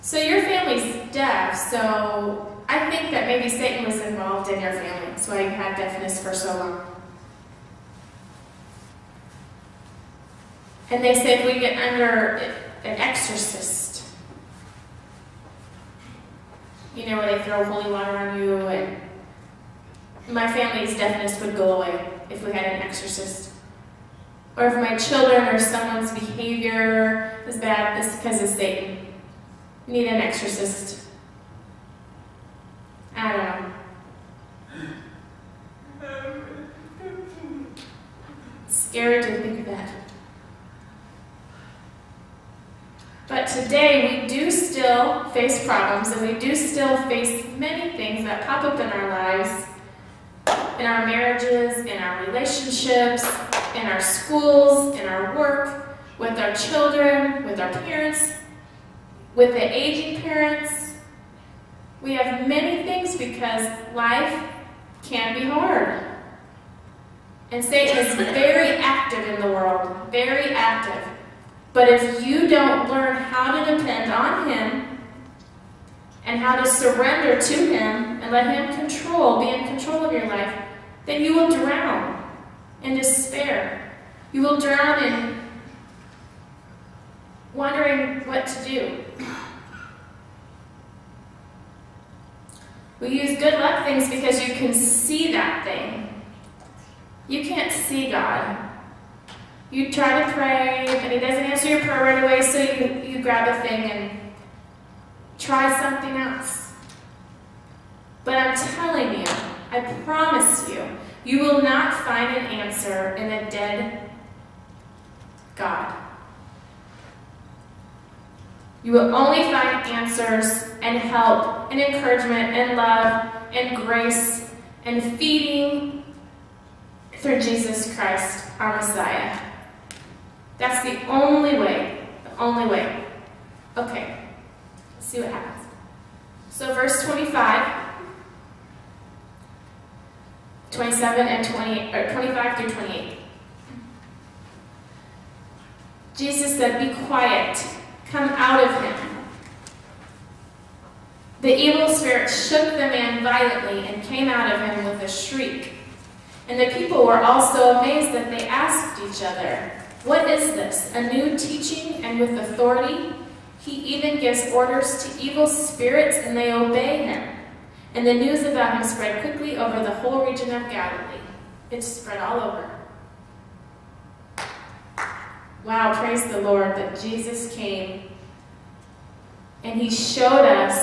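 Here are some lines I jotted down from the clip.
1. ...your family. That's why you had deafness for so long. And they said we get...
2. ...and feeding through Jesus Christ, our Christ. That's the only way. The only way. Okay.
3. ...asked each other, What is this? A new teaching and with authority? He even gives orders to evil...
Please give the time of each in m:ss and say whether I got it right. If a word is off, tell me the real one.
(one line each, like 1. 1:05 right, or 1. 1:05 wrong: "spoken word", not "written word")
1. 0:04 right
2. 2:04 wrong: "Messiah", not "Christ"
3. 2:38 right.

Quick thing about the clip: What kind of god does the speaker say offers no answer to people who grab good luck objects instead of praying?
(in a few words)
a dead God.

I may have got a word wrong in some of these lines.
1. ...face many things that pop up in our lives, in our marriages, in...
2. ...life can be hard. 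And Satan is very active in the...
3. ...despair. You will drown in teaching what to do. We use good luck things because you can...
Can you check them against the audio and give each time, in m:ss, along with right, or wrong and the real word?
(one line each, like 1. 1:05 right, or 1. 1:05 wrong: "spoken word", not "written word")
1. 0:47 right
2. 1:03 right
3. 1:22 wrong: "wondering", not "teaching".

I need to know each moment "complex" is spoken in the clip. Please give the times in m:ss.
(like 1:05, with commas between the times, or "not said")
not said.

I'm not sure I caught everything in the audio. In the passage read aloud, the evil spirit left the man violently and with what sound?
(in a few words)
a shriek.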